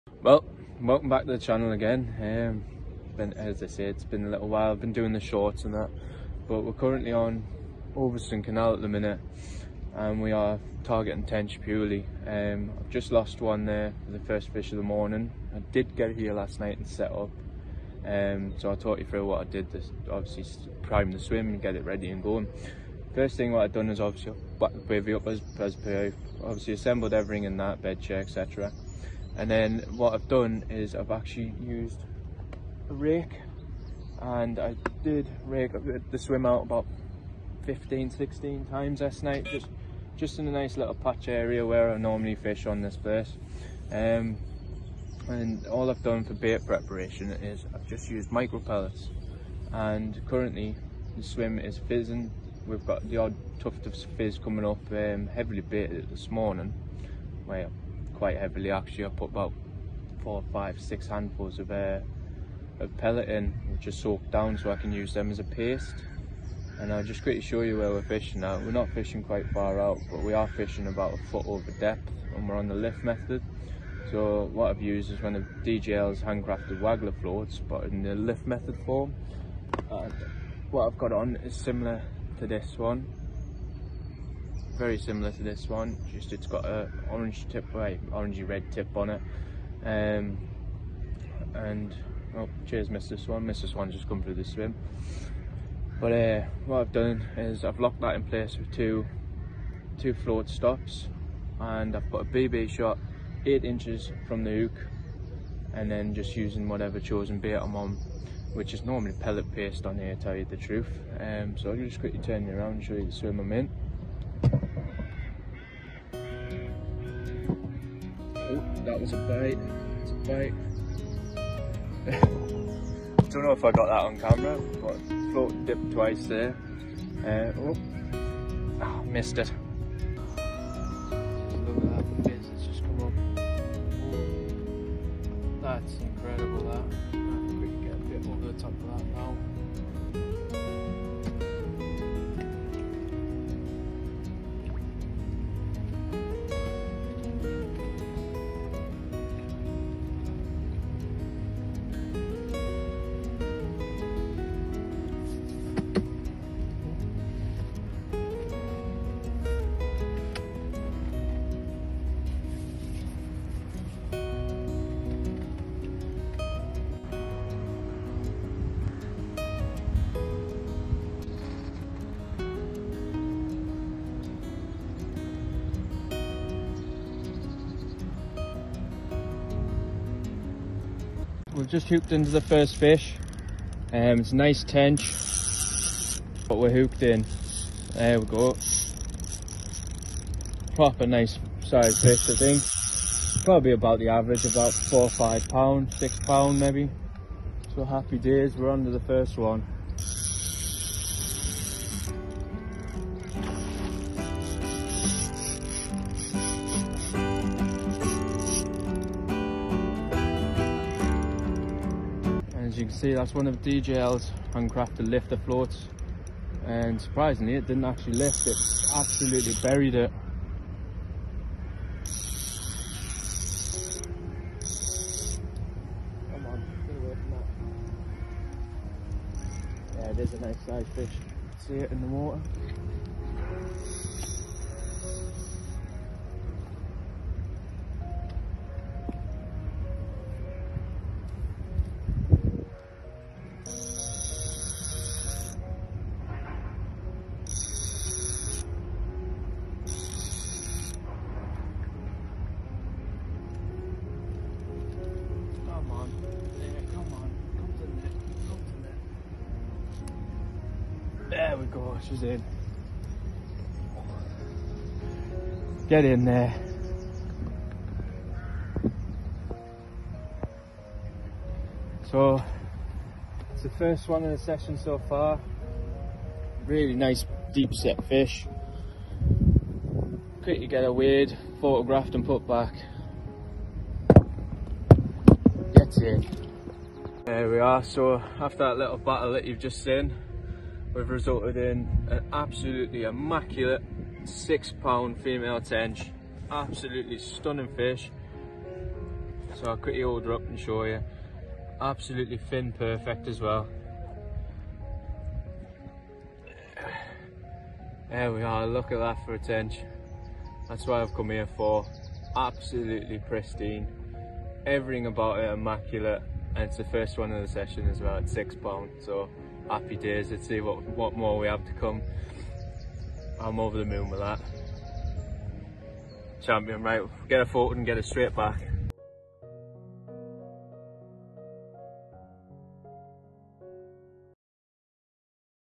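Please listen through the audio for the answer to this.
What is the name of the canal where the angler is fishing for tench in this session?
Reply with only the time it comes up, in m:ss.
0:07.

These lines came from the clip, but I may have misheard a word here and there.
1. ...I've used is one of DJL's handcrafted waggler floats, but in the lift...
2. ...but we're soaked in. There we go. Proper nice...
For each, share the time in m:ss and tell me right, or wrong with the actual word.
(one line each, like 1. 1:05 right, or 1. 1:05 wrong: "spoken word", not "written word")
1. 1:14 right
2. 3:06 wrong: "hooked", not "soaked".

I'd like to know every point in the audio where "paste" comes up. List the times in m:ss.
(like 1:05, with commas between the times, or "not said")
1:05, 1:49.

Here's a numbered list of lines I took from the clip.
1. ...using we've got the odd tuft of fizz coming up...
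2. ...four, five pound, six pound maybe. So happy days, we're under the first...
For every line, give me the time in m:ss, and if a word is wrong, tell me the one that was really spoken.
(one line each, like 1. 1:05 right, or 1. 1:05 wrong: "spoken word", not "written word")
1. 0:51 wrong: "fizzing", not "using"
2. 3:14 right.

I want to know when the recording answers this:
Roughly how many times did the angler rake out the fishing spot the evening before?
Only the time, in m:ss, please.
0:37.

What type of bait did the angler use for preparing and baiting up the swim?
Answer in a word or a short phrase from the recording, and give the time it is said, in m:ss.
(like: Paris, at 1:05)
Micro pellets, at 0:48.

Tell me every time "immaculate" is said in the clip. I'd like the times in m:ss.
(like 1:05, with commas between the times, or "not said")
4:53, 5:15.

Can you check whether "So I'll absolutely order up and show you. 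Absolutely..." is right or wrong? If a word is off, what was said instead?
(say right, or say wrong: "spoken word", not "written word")
wrong: "quickly", not "absolutely".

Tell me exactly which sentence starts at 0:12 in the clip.
Um, I've just lost one there for the first fish of the morning.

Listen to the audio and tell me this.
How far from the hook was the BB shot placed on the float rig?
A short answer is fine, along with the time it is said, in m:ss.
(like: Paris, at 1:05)
8 inches, at 1:43.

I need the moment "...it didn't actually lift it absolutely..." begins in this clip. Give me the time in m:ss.
3:37.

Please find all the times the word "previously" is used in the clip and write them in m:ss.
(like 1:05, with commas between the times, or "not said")
not said.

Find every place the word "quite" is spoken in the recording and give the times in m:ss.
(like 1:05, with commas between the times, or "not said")
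0:58, 1:09.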